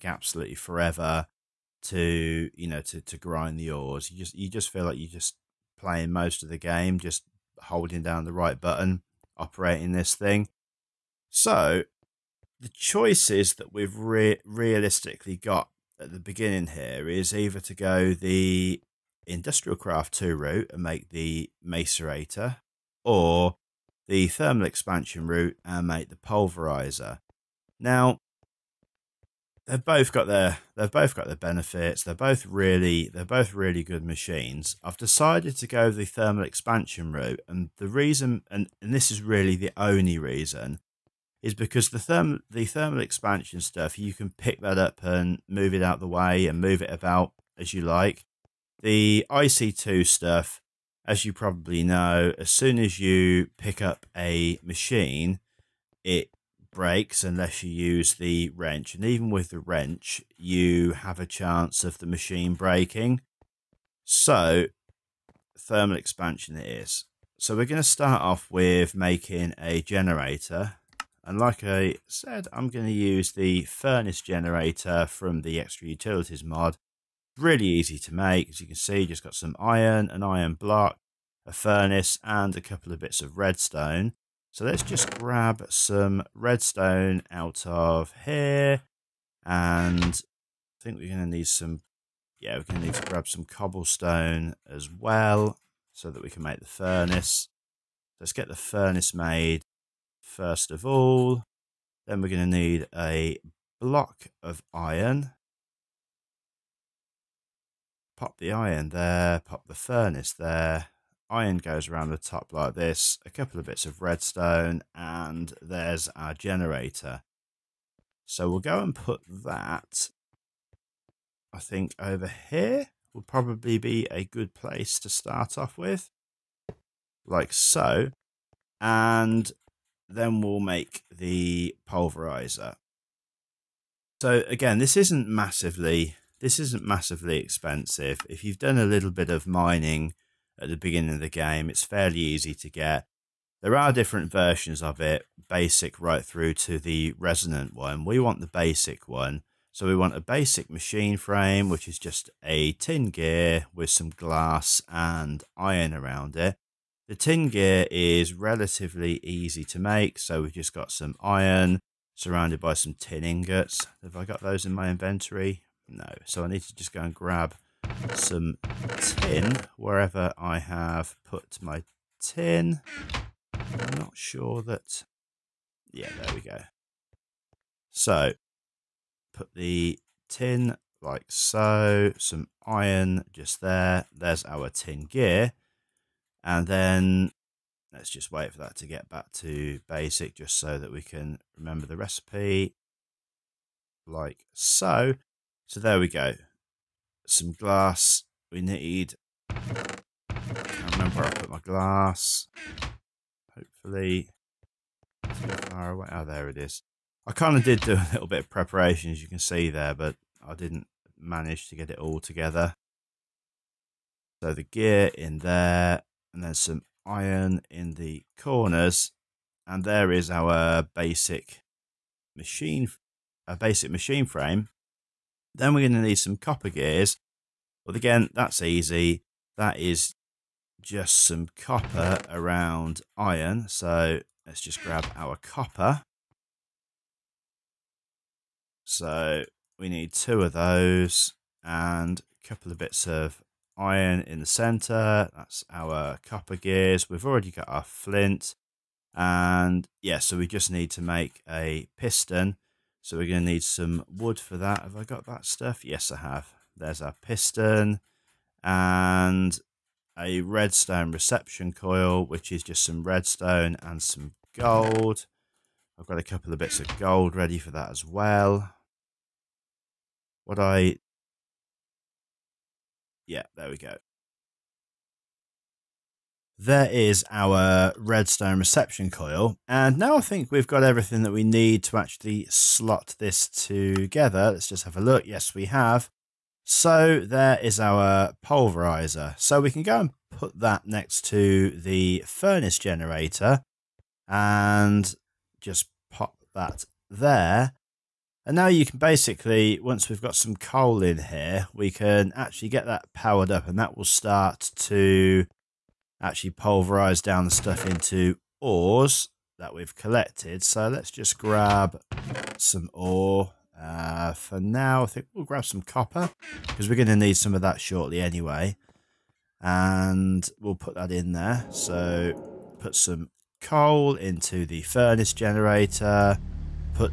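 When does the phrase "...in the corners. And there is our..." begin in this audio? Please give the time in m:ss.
3:37.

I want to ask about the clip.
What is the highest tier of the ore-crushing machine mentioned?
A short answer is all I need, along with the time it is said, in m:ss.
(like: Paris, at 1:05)
Resonant, at 2:27.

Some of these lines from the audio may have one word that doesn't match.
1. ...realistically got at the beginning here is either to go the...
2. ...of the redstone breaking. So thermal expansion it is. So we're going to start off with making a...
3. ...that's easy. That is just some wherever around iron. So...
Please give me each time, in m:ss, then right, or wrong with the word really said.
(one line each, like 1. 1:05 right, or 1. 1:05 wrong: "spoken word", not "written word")
1. 0:14 right
2. 1:01 wrong: "machine", not "redstone"
3. 3:48 wrong: "copper", not "wherever".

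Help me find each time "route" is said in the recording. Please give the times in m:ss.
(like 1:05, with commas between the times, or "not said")
0:20, 0:25, 0:37.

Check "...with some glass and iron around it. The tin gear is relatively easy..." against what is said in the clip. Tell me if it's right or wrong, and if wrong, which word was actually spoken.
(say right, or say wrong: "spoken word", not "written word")
right.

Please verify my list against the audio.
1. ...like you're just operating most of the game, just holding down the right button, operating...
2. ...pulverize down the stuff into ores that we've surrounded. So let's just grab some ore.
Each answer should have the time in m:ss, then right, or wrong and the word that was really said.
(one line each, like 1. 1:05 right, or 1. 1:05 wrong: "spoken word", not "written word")
1. 0:04 wrong: "playing", not "operating"
2. 5:06 wrong: "collected", not "surrounded".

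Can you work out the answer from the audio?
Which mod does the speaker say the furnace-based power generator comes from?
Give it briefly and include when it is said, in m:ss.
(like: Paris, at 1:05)
Extra Utilities, at 1:15.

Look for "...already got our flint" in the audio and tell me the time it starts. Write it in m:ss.
4:07.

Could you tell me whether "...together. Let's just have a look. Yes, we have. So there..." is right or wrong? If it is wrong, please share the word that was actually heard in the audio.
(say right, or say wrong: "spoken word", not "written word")
right.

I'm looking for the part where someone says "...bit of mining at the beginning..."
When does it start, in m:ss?
2:19.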